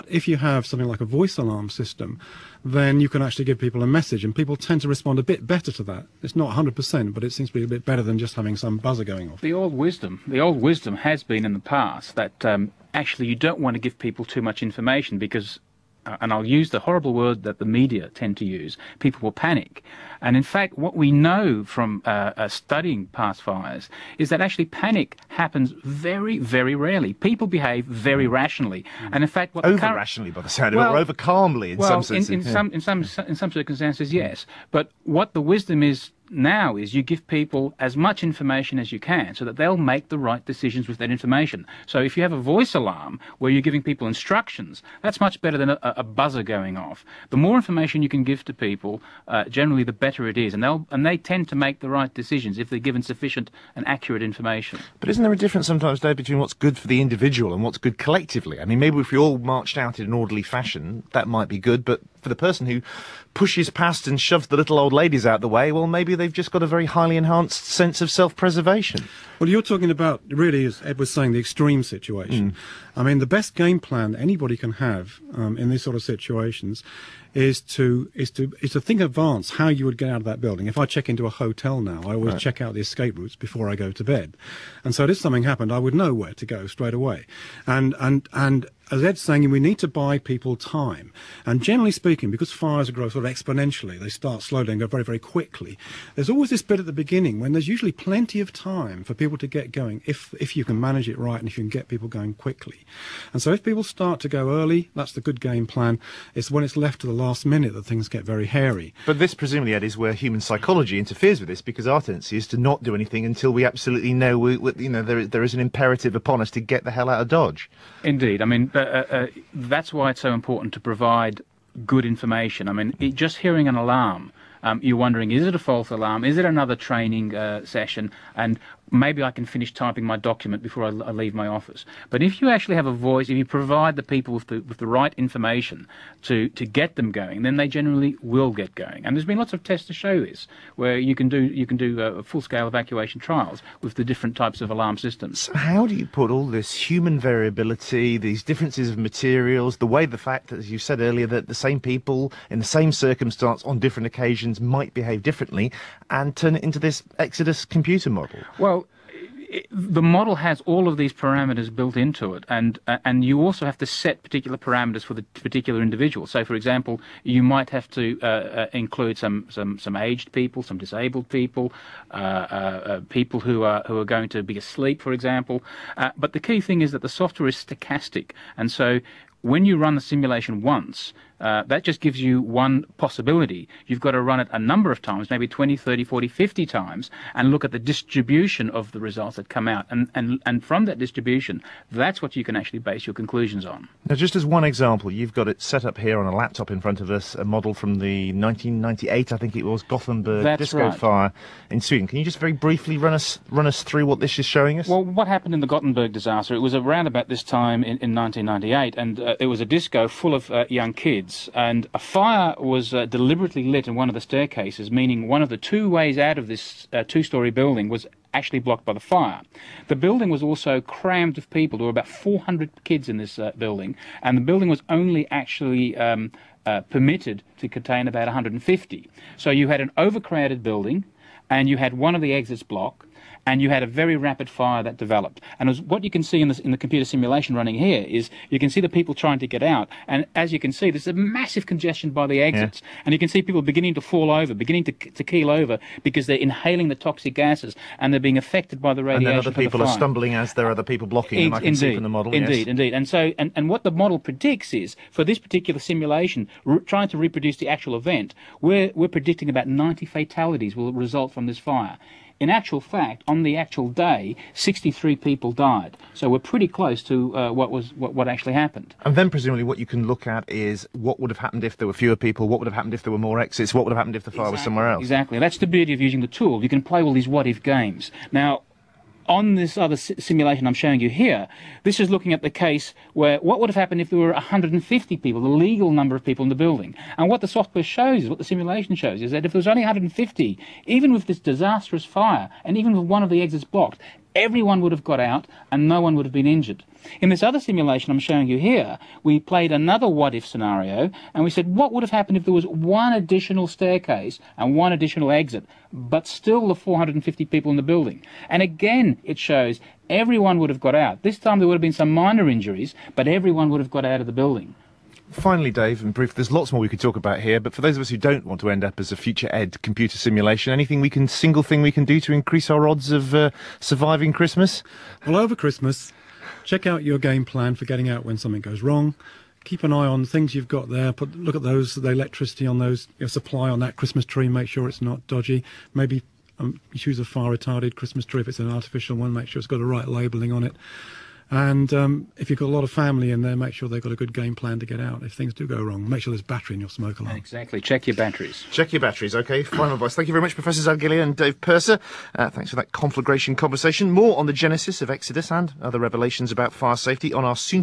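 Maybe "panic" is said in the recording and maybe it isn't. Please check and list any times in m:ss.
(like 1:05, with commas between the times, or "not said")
0:19, 0:24.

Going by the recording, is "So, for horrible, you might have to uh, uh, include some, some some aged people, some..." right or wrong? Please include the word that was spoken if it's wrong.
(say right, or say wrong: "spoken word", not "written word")
wrong: "example", not "horrible".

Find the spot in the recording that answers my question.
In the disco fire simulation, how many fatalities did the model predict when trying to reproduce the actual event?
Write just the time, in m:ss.
4:19.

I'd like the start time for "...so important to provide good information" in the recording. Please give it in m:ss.
2:00.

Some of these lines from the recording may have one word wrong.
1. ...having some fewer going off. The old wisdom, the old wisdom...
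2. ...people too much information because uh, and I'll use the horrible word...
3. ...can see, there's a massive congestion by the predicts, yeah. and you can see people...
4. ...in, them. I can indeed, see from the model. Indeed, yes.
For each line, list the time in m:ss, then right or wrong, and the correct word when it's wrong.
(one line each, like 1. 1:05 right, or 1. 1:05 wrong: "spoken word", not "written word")
1. 0:08 wrong: "buzzer", not "fewer"
2. 0:13 right
3. 4:00 wrong: "exits", not "predicts"
4. 4:11 right.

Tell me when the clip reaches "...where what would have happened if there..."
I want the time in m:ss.
4:43.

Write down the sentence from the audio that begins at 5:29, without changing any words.
Keep an eye on things you've got there.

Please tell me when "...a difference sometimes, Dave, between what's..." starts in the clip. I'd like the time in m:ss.
0:55.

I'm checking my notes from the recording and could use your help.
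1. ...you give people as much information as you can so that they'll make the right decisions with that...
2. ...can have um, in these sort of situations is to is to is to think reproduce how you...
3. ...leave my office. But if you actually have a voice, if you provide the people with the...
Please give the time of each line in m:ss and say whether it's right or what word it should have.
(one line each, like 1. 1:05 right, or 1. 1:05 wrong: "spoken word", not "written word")
1. 0:36 right
2. 1:14 wrong: "advance", not "reproduce"
3. 2:11 right.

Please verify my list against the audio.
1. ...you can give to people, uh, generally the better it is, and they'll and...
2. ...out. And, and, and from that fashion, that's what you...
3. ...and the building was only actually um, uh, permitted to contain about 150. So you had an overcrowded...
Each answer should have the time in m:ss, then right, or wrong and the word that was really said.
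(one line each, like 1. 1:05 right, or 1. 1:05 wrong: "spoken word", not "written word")
1. 0:48 right
2. 3:09 wrong: "distribution", not "fashion"
3. 3:44 right.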